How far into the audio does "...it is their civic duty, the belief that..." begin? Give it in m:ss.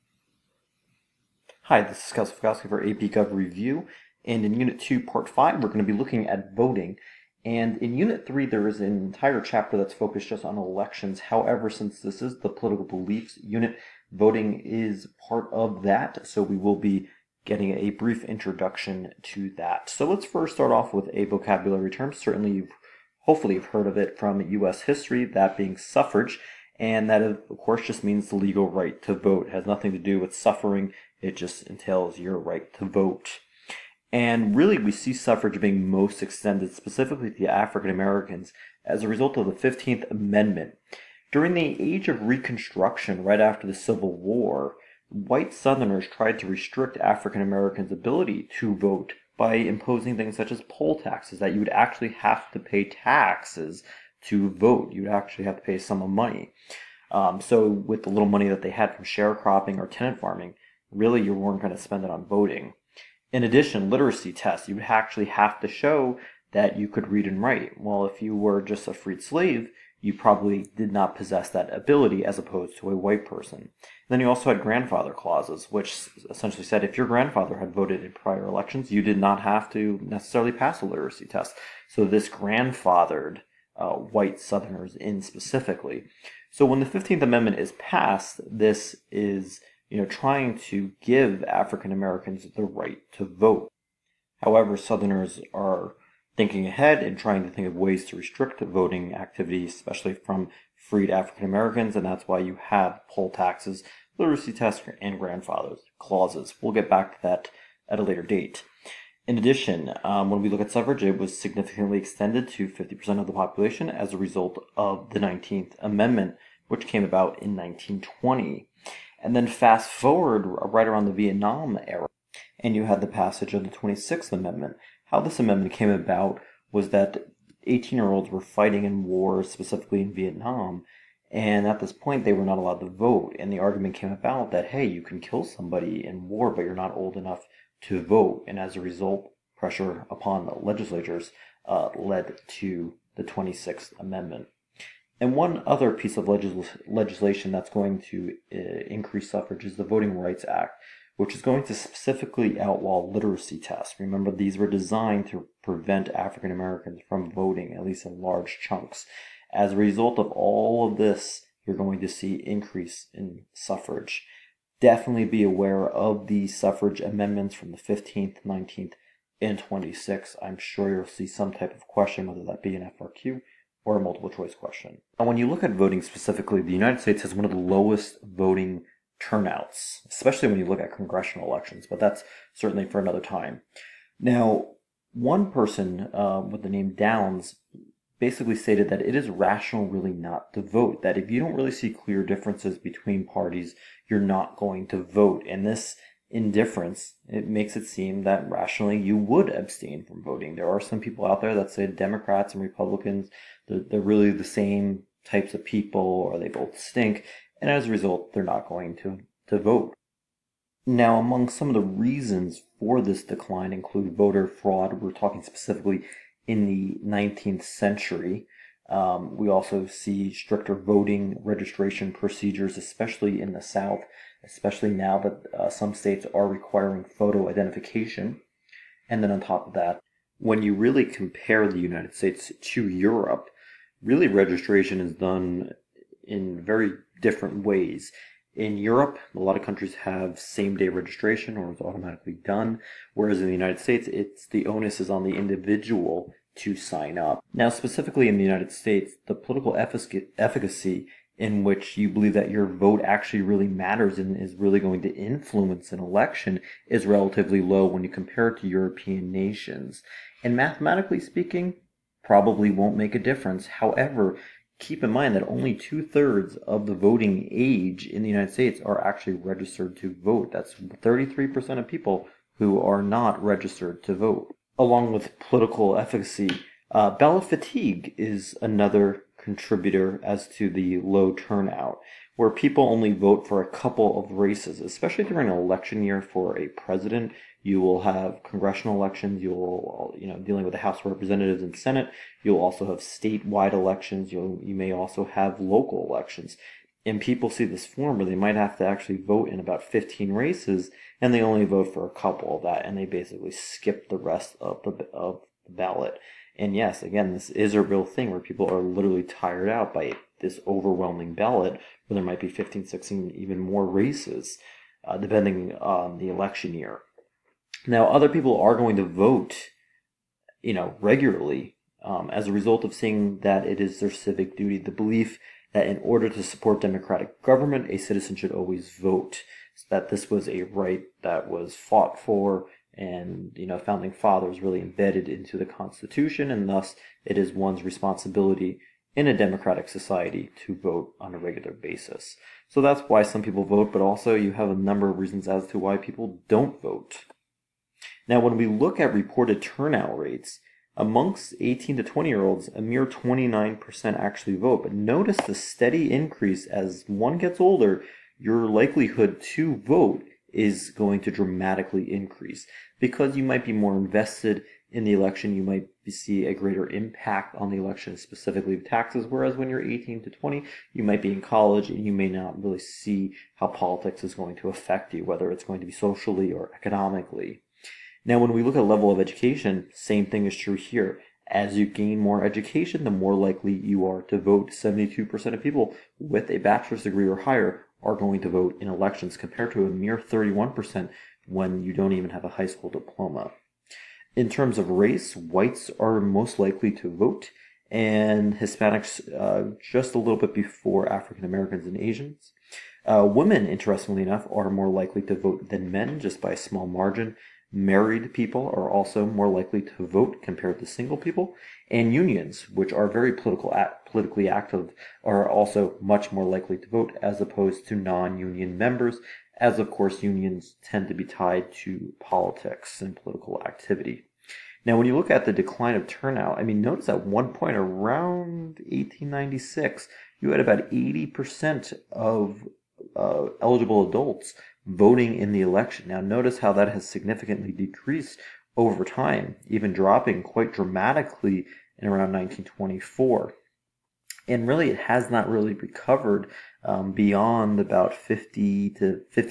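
5:23.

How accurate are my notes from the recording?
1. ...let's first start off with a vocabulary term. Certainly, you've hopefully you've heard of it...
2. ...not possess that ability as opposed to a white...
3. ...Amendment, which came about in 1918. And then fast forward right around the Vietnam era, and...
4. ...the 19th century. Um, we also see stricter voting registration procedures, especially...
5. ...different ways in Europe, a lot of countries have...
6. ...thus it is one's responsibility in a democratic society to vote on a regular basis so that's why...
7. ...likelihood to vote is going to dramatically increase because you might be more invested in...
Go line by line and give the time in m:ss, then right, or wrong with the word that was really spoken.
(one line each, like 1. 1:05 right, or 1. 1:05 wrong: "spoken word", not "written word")
1. 0:20 right
2. 1:10 right
3. 1:55 wrong: "1920", not "1918"
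4. 3:36 right
5. 3:57 right
6. 5:36 right
7. 5:58 right.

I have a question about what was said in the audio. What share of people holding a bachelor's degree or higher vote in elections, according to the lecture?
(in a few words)
72%.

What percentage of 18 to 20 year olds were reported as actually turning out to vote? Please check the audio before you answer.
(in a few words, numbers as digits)
29%.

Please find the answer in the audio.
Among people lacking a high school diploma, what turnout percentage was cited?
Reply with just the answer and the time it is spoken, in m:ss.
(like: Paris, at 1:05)
31%, at 6:30.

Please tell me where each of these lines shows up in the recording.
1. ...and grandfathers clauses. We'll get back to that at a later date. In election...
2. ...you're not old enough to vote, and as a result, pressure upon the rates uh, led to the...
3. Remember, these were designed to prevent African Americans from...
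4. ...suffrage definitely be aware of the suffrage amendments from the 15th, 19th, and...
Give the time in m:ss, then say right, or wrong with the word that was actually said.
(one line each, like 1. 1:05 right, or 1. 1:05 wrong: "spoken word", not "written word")
1. 1:44 wrong: "addition", not "election"
2. 2:16 wrong: "legislatures", not "rates"
3. 2:33 right
4. 2:43 right.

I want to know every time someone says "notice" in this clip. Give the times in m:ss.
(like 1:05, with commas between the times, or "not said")
5:54, 7:06, 7:16.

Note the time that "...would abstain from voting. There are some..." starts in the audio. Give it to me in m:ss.
3:19.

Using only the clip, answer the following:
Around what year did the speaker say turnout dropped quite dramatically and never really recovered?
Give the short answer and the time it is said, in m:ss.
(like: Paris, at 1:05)
1924, at 7:22.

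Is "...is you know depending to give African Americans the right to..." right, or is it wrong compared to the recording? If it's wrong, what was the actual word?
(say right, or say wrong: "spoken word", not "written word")
wrong: "trying", not "depending".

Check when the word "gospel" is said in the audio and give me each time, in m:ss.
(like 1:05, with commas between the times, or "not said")
not said.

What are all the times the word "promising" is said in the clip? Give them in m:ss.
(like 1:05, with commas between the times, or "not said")
not said.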